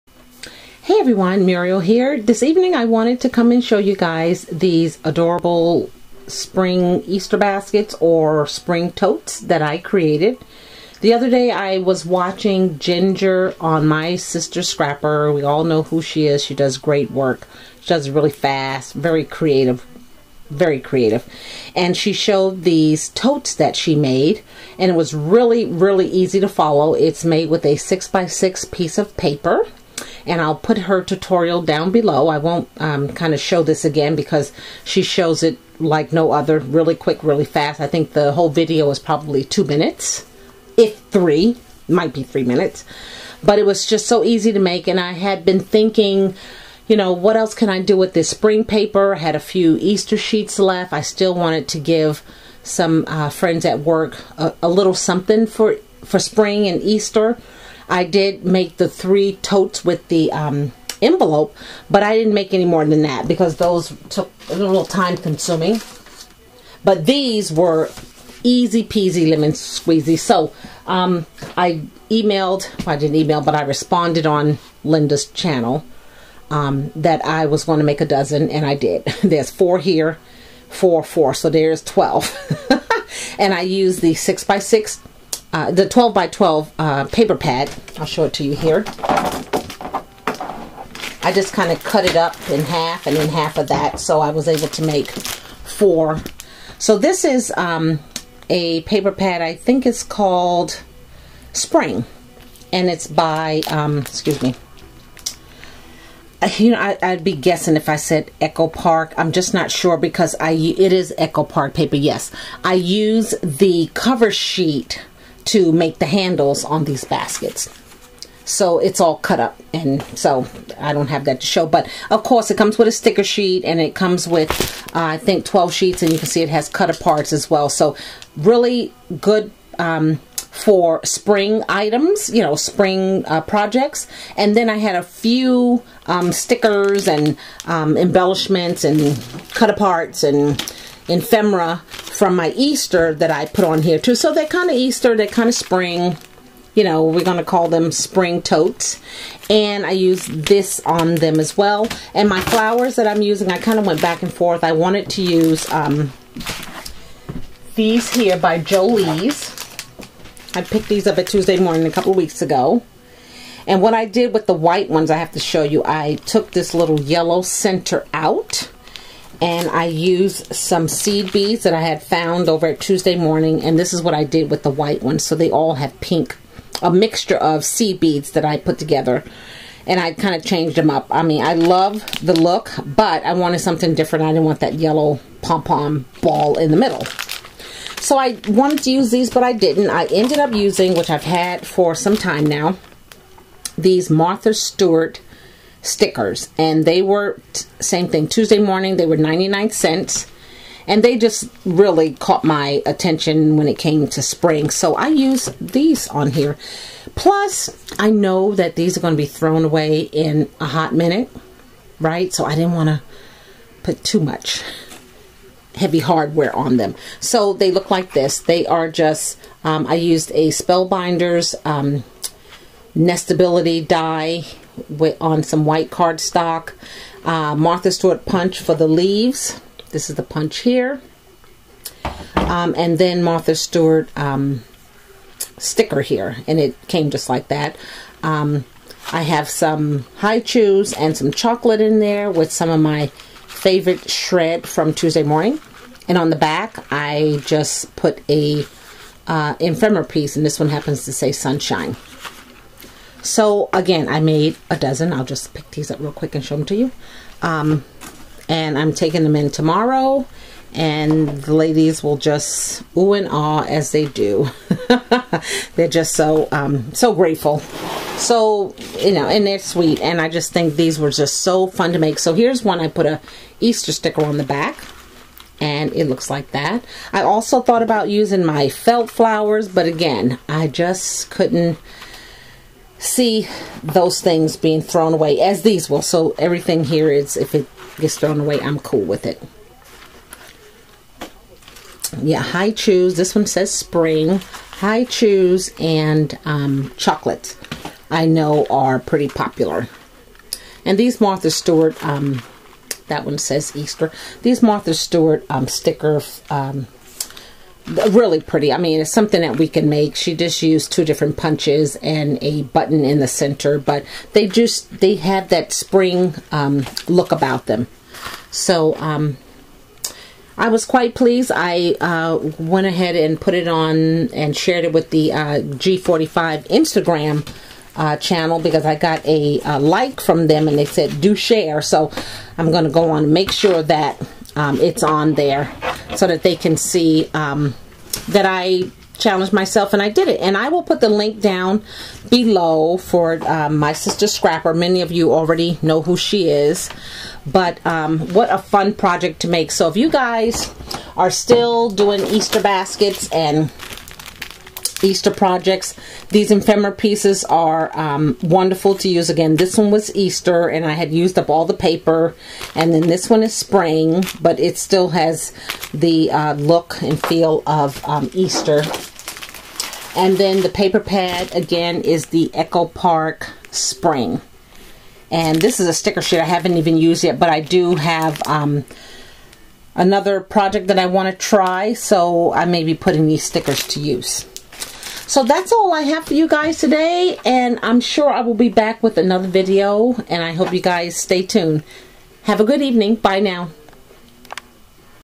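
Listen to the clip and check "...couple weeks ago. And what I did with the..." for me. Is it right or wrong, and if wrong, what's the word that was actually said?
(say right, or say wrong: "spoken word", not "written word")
right.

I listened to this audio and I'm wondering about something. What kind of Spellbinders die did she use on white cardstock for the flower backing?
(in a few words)
Nestability.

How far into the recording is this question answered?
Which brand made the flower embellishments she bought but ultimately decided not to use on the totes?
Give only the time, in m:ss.
2:38.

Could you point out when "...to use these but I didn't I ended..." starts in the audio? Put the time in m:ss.
3:08.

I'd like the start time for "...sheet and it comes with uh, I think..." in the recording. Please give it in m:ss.
2:03.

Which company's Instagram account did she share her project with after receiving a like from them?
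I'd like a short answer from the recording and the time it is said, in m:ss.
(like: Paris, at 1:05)
G45, at 5:25.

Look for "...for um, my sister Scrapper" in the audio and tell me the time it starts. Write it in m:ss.
5:42.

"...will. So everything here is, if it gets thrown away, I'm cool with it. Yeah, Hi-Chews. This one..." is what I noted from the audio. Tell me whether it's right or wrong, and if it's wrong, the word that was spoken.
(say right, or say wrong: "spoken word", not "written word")
right.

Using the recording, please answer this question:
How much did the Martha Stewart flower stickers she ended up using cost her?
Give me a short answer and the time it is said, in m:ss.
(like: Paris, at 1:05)
99 cents, at 3:19.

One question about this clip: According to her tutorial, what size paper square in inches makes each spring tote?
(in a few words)
6 by 6.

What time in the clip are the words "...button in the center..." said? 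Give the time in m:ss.
5:12.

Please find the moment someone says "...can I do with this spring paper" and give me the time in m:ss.
0:47.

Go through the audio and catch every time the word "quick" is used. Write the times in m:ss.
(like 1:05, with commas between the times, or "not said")
0:36, 4:16.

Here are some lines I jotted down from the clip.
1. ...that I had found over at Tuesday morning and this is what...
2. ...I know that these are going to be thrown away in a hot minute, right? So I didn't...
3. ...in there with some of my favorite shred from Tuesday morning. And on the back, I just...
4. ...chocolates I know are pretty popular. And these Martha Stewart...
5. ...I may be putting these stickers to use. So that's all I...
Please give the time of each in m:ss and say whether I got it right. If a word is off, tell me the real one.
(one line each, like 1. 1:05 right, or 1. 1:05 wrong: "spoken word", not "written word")
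1. 2:51 right
2. 3:27 right
3. 4:01 right
4. 4:56 right
5. 6:22 right.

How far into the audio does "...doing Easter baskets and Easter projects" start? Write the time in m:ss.
5:51.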